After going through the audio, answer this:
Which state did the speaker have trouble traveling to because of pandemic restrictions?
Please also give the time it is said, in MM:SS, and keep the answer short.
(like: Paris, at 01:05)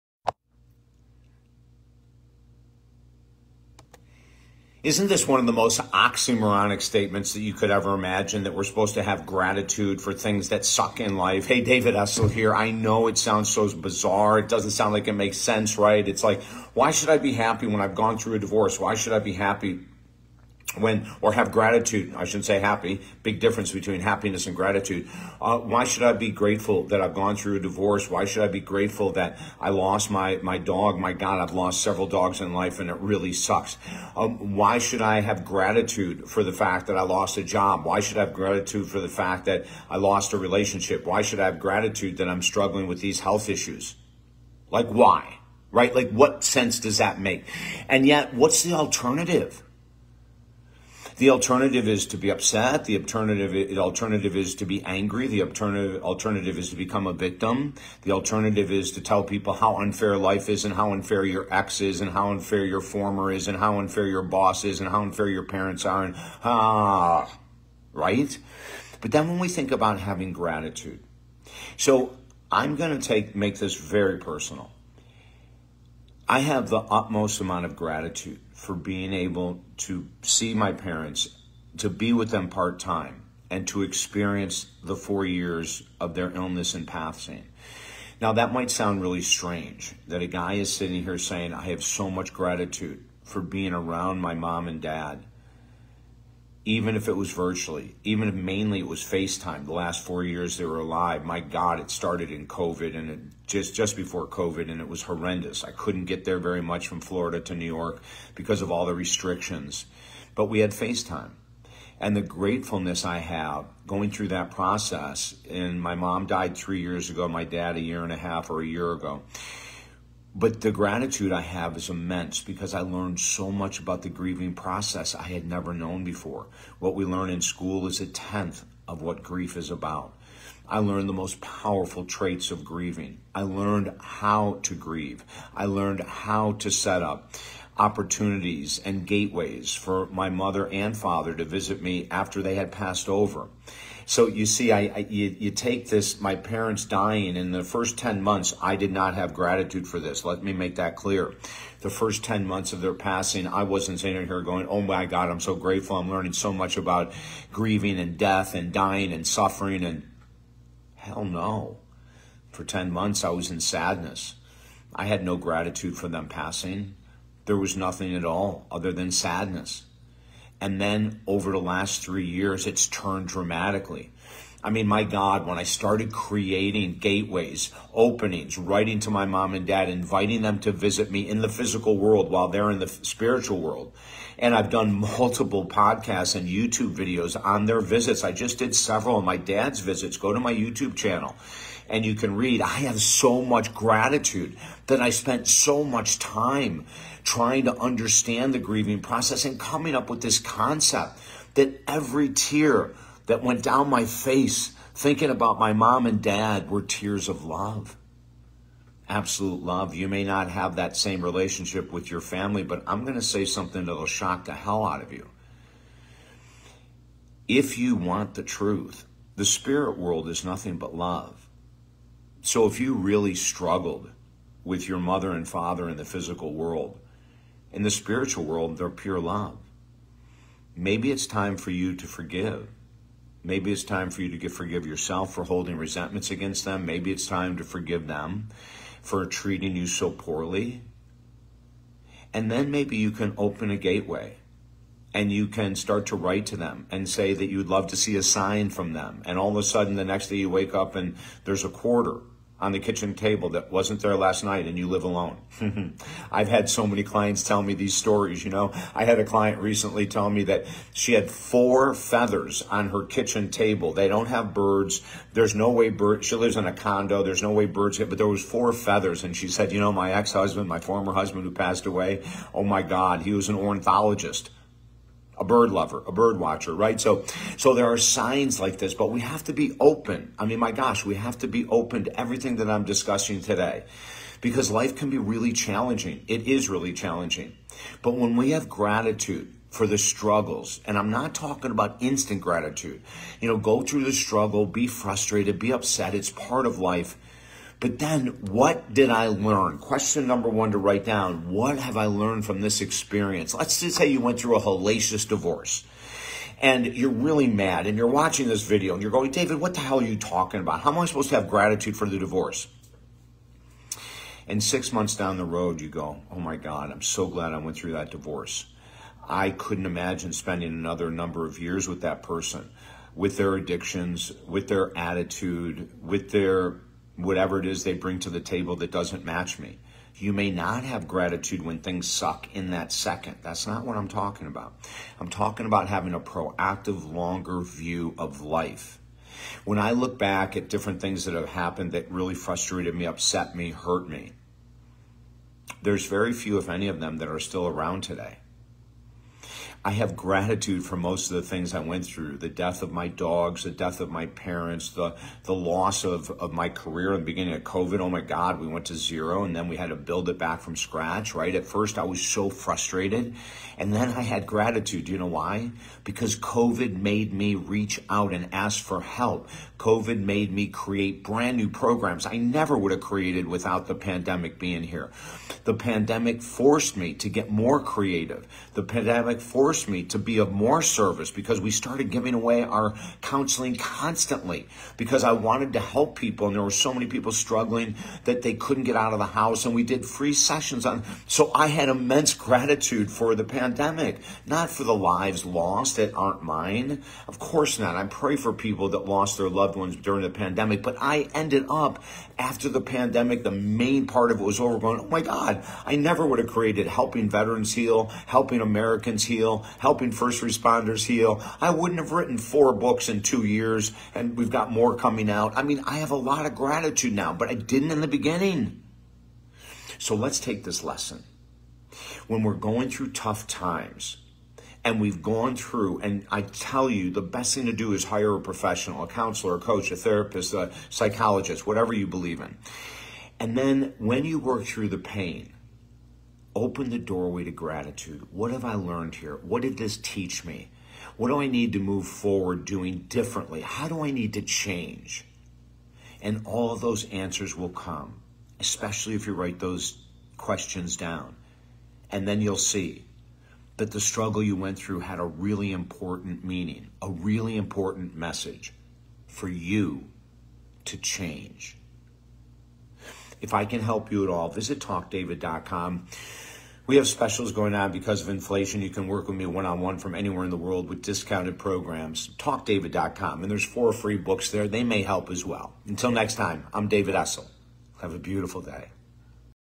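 New York, at 01:47.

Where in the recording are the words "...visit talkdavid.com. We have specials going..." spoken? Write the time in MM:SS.
07:44.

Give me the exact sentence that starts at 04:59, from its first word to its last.
Question number one to write down.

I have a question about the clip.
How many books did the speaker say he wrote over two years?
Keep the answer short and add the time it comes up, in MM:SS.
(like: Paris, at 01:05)
4, at 06:52.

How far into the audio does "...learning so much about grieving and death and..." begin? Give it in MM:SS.
02:36.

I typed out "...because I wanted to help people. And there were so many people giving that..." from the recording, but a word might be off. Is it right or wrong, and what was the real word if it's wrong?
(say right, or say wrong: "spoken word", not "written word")
wrong: "struggling", not "giving".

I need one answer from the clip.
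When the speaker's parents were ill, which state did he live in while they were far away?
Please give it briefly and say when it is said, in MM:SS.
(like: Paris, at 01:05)
Florida, at 01:47.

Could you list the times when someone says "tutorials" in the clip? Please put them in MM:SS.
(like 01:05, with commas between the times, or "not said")
not said.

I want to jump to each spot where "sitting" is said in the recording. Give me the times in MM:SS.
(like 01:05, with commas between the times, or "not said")
01:30, 02:34.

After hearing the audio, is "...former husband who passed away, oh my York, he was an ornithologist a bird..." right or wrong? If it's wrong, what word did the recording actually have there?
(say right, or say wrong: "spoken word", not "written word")
wrong: "God", not "York".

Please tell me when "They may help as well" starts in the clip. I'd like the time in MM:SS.
07:54.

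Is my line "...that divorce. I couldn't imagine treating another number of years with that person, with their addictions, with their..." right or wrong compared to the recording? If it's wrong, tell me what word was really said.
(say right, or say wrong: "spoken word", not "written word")
wrong: "spending", not "treating".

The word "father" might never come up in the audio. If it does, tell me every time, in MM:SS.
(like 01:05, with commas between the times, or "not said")
02:20, 03:45.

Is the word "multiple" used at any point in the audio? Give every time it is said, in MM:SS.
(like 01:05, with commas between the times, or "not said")
03:05.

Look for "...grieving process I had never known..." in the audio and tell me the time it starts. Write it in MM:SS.
02:04.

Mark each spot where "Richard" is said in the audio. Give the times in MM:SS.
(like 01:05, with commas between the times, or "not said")
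not said.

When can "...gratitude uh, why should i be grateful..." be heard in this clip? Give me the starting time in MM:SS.
00:24.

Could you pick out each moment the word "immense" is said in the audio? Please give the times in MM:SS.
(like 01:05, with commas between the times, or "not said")
02:01, 06:31.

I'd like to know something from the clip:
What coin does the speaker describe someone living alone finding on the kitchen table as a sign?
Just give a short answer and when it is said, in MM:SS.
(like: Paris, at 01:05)
A quarter, at 04:11.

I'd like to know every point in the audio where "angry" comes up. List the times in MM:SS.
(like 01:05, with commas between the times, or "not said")
00:54.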